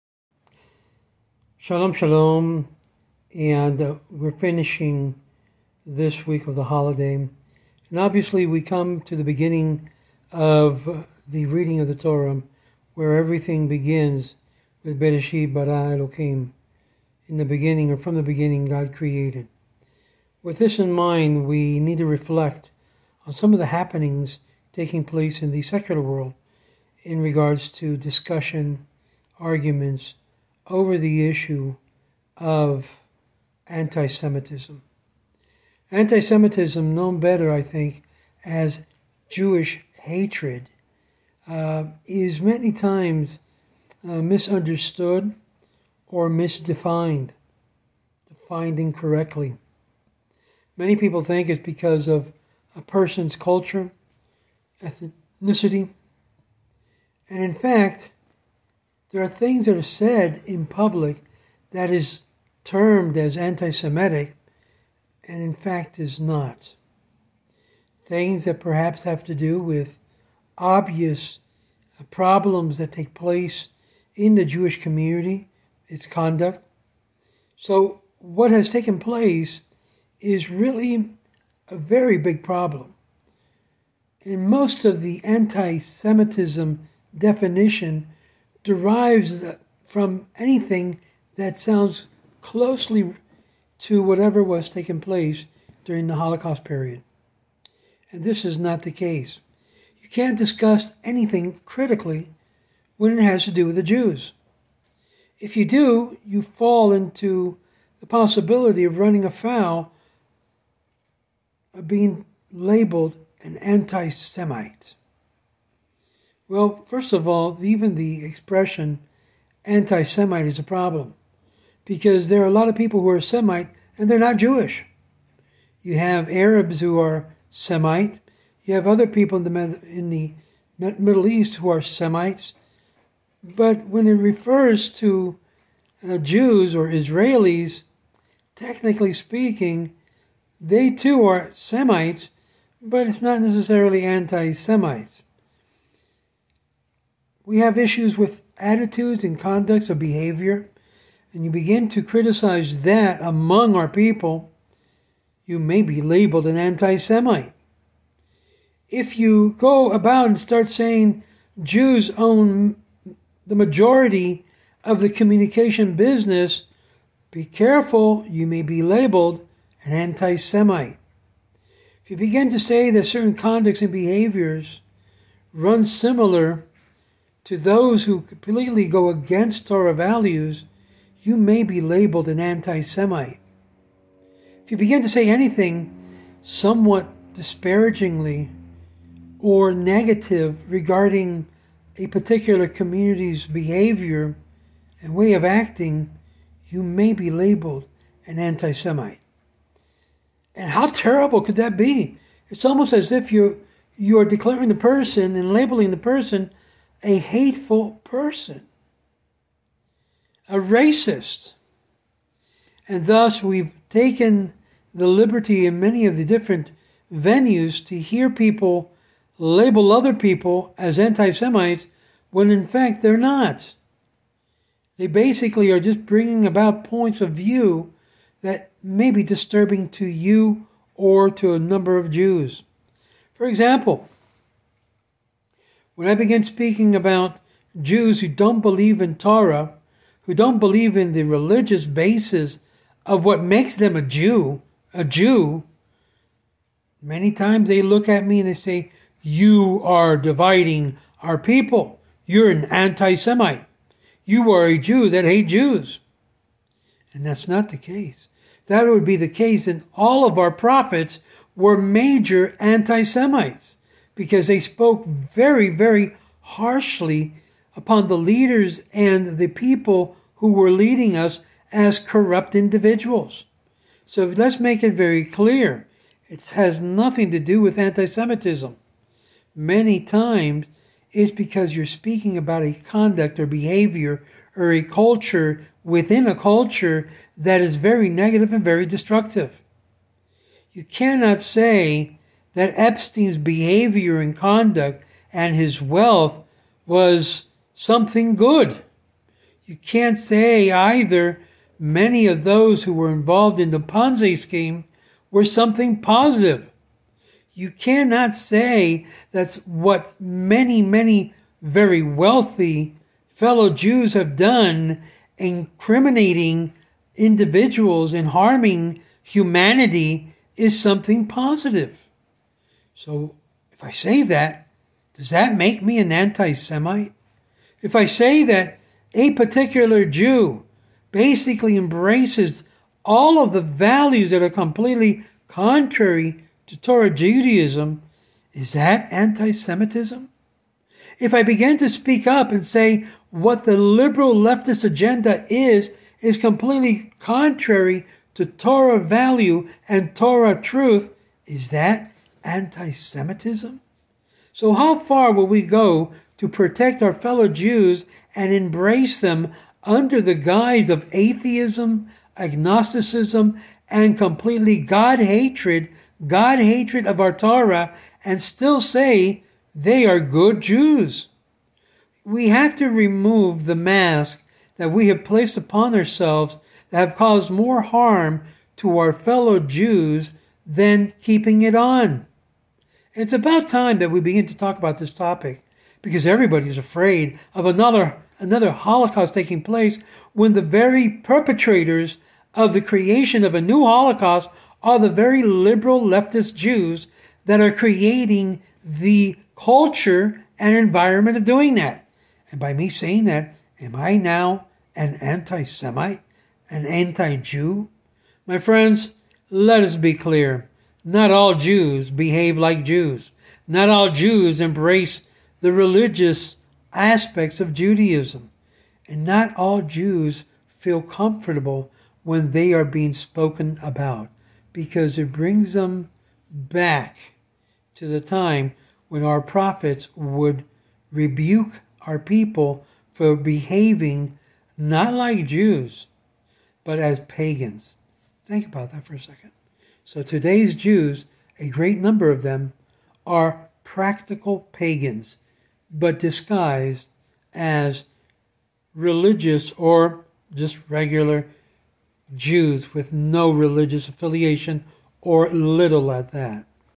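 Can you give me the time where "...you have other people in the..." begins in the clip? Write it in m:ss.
2:08.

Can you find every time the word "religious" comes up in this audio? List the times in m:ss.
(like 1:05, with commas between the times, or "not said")
4:01, 6:55, 7:28, 7:33.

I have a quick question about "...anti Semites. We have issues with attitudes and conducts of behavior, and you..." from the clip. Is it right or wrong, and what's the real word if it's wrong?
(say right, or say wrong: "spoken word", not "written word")
right.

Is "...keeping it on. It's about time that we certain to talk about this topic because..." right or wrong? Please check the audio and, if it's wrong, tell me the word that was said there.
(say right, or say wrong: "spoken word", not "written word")
wrong: "begin", not "certain".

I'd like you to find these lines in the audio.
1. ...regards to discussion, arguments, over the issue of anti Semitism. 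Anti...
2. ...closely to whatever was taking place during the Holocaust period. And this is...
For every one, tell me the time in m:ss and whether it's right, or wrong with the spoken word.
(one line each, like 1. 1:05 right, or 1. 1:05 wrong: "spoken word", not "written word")
1. 0:27 right
2. 1:32 right.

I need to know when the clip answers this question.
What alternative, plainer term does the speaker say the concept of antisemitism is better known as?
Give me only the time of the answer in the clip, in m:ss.
0:39.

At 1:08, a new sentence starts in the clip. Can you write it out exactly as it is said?
Things that perhaps have to do with obvious problems that take place in the Jewish community, its conduct.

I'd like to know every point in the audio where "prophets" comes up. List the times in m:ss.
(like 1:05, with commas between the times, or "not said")
4:20, 7:09.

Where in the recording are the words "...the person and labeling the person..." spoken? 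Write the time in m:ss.
3:24.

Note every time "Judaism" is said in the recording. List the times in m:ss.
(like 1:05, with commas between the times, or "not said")
5:37, 6:57.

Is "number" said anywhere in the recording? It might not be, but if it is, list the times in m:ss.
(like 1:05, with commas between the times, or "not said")
3:51, 7:21.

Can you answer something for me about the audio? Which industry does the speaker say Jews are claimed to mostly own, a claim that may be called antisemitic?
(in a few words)
communication business.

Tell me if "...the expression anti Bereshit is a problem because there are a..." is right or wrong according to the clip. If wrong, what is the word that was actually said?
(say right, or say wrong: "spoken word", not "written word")
wrong: "Semite", not "Bereshit".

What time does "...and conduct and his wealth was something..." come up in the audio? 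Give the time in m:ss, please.
4:54.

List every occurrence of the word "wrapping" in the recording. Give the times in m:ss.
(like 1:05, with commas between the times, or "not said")
not said.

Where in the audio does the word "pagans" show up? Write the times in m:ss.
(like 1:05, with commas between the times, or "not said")
7:17, 7:24.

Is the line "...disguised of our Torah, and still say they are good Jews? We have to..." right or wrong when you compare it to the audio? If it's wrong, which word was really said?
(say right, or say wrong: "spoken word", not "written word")
wrong: "hatred", not "disguised".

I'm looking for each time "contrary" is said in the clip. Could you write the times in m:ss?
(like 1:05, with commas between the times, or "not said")
5:35, 5:47.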